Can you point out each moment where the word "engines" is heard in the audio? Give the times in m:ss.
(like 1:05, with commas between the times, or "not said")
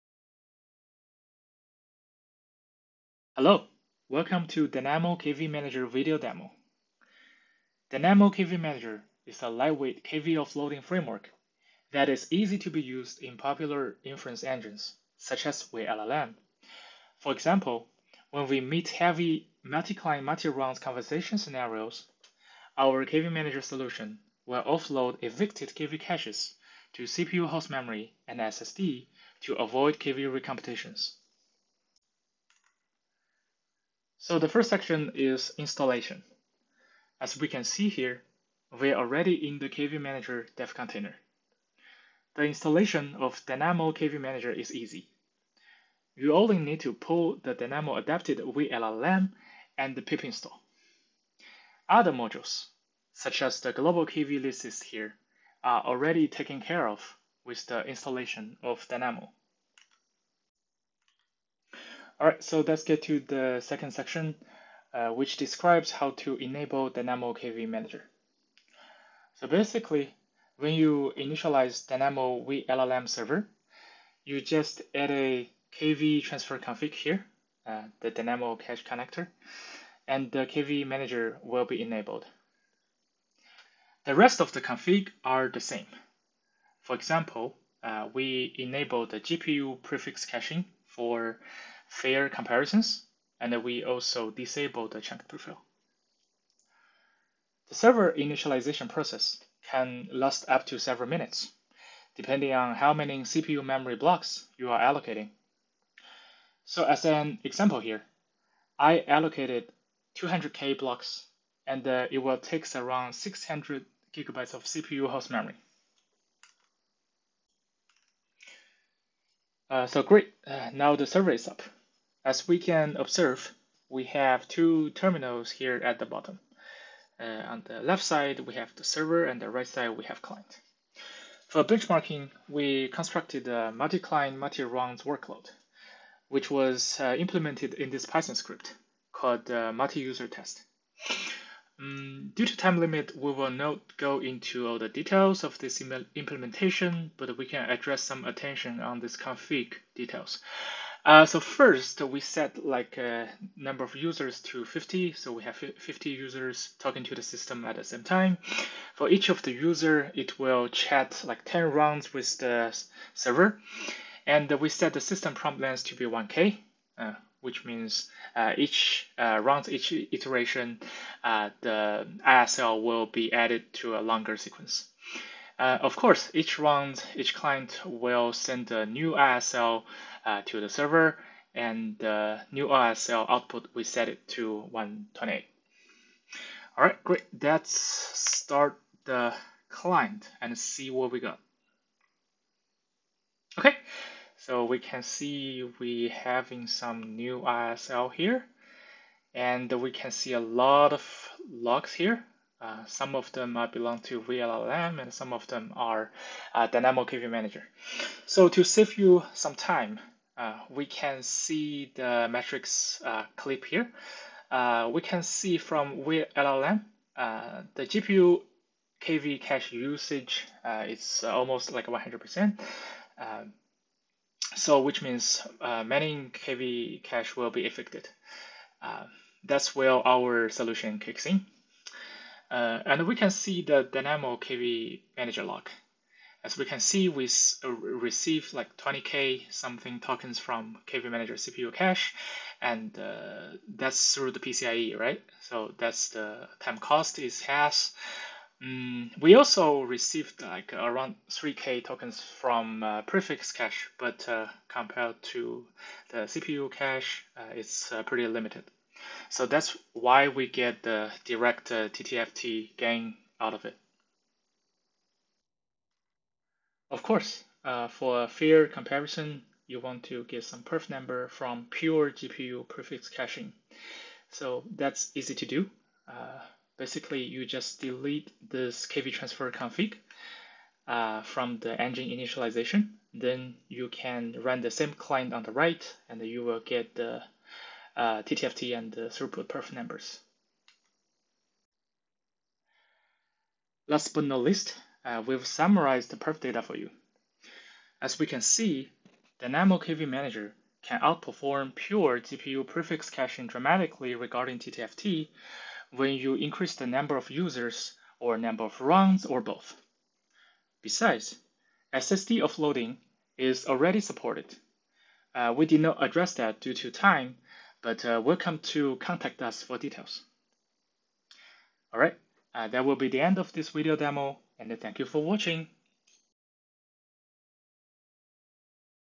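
0:14, 4:41.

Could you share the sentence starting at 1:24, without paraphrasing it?
The rest of the config are the same.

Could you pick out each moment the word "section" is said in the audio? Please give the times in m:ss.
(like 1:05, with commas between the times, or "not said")
0:34, 1:03.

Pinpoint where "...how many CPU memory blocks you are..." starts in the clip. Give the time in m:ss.
1:42.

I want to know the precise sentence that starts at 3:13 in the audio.
Okay, so we can see we having some new ISL here and we can see a lot of logs here.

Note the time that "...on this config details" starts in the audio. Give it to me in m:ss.
2:28.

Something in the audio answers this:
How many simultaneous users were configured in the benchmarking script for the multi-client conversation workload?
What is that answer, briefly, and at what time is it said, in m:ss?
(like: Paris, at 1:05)
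50, at 2:35.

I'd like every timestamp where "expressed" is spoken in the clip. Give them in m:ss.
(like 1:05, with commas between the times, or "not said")
not said.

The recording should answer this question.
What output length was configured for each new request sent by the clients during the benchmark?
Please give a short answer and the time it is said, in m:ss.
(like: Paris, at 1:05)
128, at 3:04.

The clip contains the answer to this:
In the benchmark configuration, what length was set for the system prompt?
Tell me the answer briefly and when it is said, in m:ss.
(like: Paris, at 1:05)
1K, at 2:46.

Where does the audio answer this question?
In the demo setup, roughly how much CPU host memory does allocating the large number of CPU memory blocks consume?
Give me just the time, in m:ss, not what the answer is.
1:53.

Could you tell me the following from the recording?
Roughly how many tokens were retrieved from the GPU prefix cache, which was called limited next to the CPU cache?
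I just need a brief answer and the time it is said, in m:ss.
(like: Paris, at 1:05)
3k, at 4:11.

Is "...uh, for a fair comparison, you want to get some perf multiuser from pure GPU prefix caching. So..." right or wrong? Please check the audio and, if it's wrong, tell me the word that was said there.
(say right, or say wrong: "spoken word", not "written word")
wrong: "number", not "multiuser".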